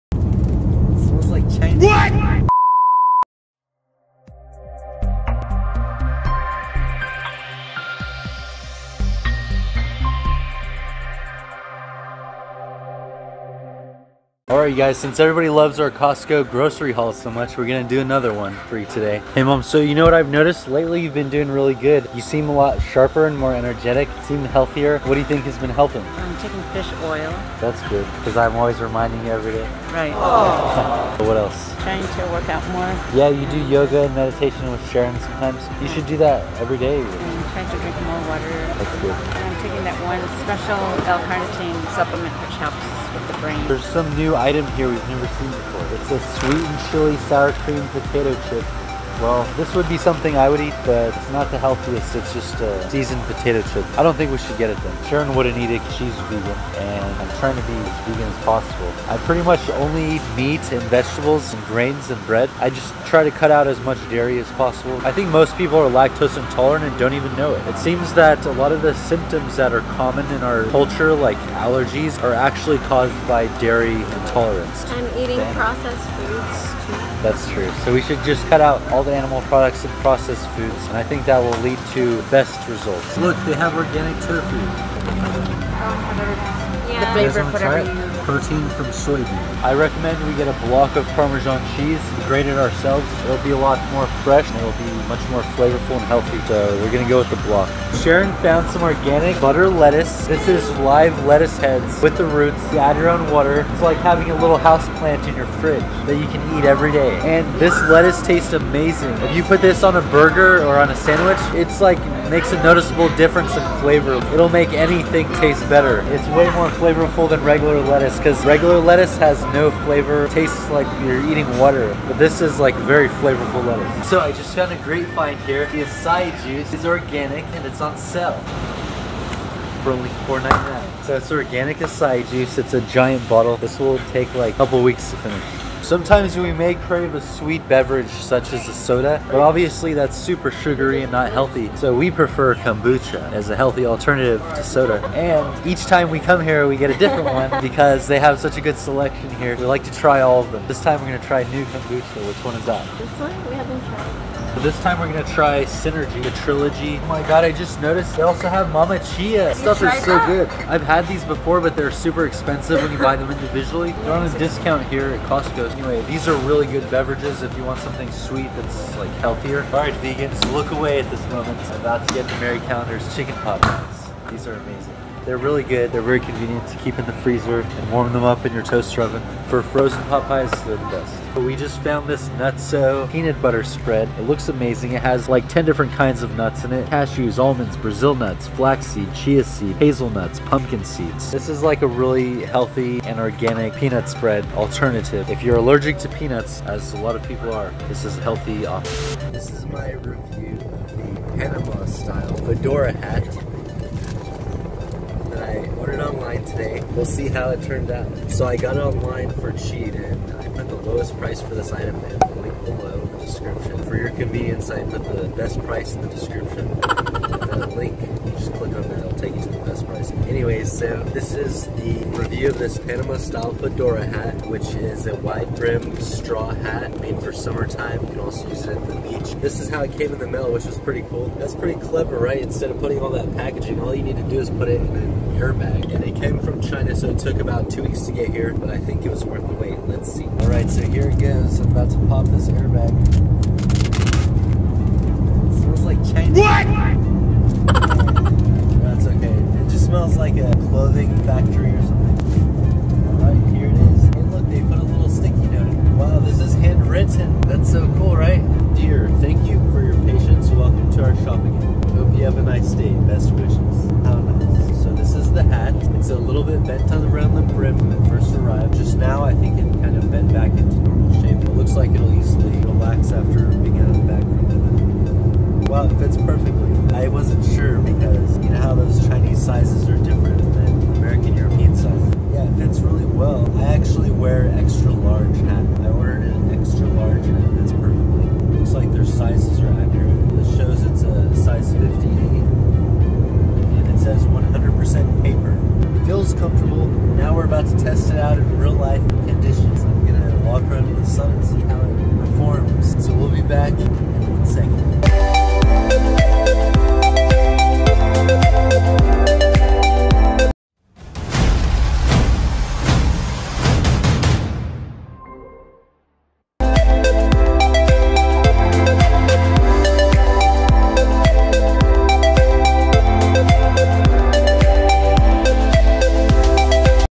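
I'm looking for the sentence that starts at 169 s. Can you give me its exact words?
All right, vegans, look away at this moment.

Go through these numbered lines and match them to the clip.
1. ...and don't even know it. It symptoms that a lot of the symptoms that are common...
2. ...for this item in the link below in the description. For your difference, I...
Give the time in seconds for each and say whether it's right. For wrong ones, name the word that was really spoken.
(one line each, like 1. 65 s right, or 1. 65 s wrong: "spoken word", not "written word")
1. 66 s wrong: "seems", not "symptoms"
2. 211 s wrong: "convenience", not "difference".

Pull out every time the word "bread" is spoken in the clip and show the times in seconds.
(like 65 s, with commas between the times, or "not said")
62 s.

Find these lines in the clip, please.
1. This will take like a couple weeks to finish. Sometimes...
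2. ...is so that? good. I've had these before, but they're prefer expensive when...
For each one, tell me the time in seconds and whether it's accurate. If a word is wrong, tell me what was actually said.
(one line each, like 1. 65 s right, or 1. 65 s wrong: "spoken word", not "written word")
1. 133 s right
2. 159 s wrong: "super", not "prefer".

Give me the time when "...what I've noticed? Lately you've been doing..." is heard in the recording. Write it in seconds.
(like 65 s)
20 s.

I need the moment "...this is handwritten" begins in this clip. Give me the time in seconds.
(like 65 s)
256 s.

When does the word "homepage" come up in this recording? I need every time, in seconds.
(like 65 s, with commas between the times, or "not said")
not said.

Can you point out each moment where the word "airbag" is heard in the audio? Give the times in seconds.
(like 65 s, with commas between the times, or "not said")
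235 s, 242 s.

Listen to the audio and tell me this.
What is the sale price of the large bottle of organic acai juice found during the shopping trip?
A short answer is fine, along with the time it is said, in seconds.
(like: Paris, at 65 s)
$4.99, at 130 s.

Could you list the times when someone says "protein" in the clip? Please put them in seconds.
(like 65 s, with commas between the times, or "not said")
88 s.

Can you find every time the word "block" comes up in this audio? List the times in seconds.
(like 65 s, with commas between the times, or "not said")
90 s, 97 s.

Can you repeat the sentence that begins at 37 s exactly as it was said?
I'm um, trying to drink more water.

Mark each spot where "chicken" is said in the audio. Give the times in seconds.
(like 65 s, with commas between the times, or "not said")
173 s.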